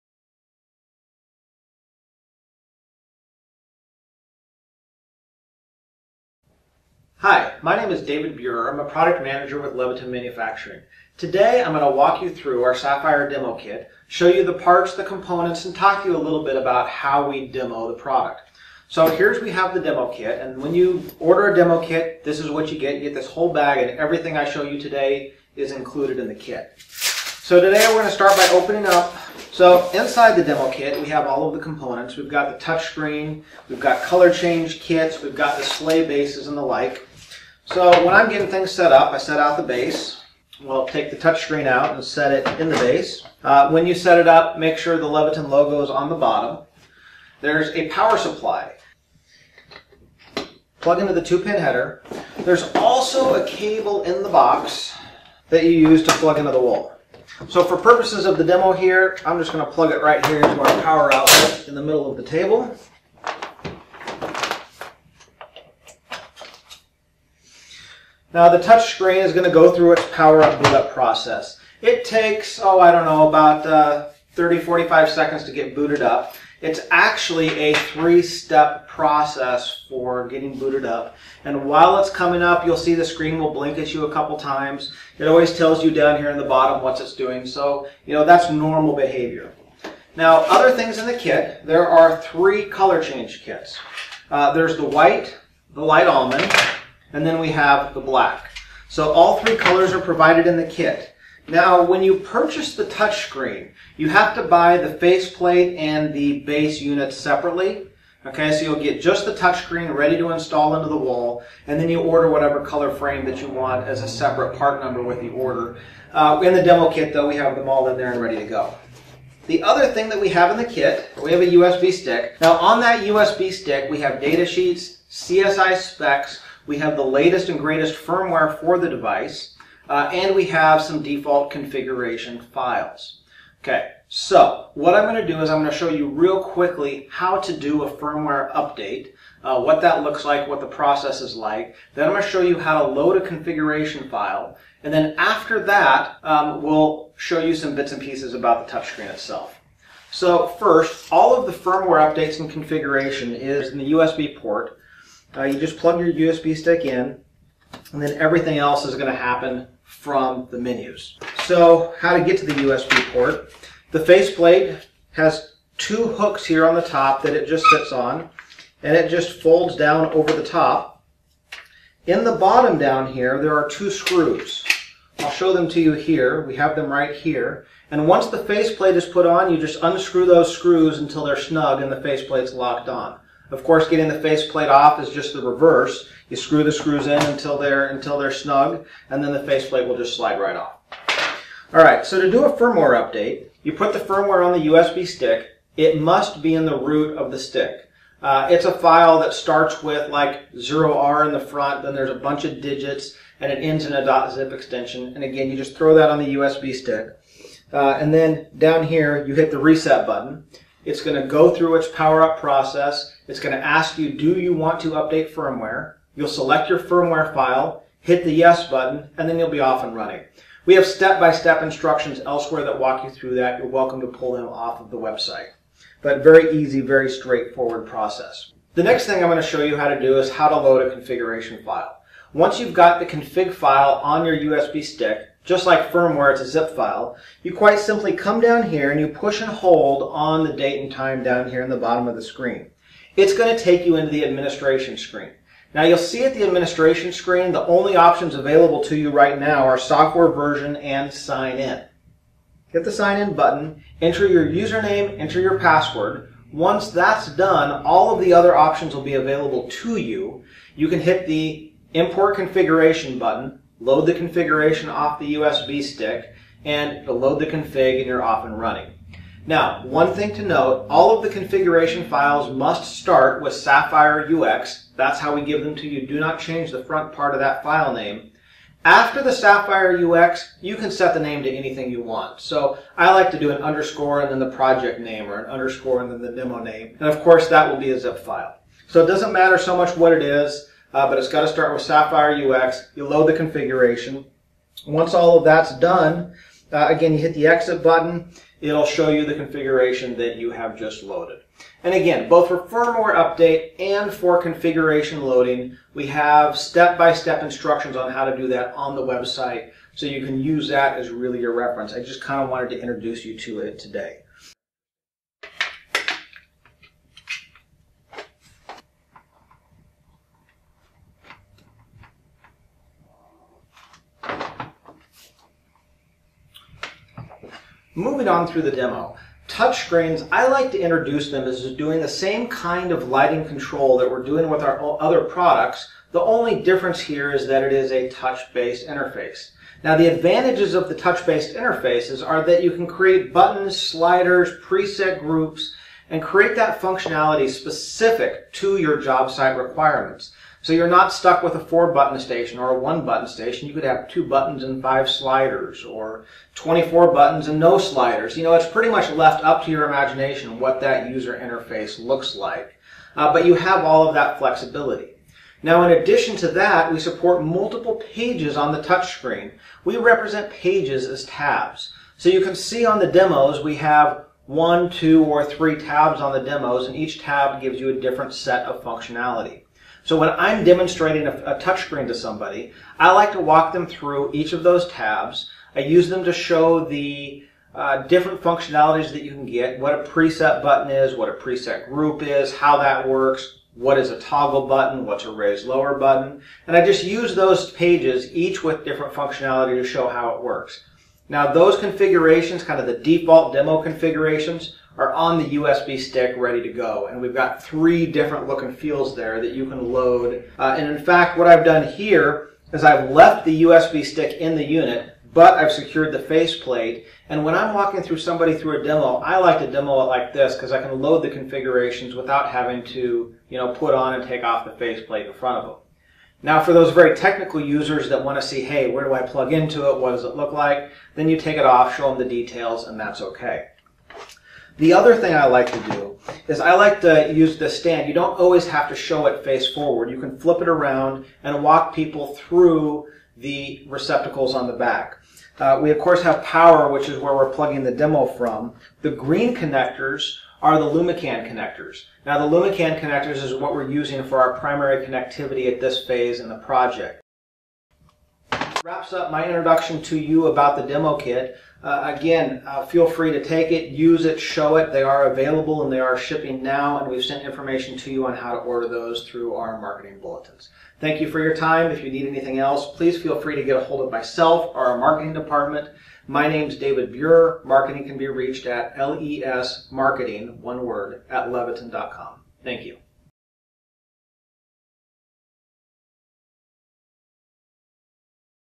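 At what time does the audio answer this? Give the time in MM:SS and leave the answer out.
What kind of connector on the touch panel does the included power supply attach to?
00:51.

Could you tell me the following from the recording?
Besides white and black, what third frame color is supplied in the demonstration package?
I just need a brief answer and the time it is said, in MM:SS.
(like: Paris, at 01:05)
light almond, at 01:35.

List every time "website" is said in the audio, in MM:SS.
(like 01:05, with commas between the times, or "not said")
03:44, 05:09.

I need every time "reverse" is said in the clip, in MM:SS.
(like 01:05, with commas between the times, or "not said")
03:05.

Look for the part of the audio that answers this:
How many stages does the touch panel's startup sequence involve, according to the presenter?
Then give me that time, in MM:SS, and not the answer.
01:17.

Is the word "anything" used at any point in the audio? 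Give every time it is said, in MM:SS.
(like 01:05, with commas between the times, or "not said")
04:41, 07:52.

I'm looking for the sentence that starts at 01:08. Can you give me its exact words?
Now the touch screen is going to go through its power up boot up process.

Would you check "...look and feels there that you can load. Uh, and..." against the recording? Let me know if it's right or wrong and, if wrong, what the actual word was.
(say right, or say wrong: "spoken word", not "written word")
right.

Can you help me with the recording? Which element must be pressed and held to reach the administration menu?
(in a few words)
date and time.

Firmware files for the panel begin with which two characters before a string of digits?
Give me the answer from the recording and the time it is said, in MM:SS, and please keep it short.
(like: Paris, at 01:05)
0R, at 03:20.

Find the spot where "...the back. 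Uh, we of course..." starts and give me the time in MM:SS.
07:24.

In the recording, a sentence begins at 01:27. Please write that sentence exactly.
So, you know, that's normal behavior.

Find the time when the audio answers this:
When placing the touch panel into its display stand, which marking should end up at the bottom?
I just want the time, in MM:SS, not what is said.
00:45.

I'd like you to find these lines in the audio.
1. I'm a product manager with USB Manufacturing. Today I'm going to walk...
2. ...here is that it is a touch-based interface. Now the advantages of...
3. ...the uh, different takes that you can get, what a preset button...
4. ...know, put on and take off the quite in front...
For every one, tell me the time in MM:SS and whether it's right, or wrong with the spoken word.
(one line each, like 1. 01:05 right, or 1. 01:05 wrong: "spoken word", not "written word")
1. 00:08 wrong: "Leviton", not "USB"
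2. 05:37 right
3. 06:26 wrong: "functionalities", not "takes"
4. 07:03 wrong: "faceplate", not "quite".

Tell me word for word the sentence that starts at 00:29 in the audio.
So inside the demo kit, we have all of the components.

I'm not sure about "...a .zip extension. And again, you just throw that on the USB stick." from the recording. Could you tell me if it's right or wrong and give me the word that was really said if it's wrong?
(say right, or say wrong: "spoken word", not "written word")
right.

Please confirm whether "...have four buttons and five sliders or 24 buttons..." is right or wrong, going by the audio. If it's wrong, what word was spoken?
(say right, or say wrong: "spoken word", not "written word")
wrong: "two", not "four".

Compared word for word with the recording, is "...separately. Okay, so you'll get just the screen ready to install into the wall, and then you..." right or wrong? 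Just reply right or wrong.
wrong.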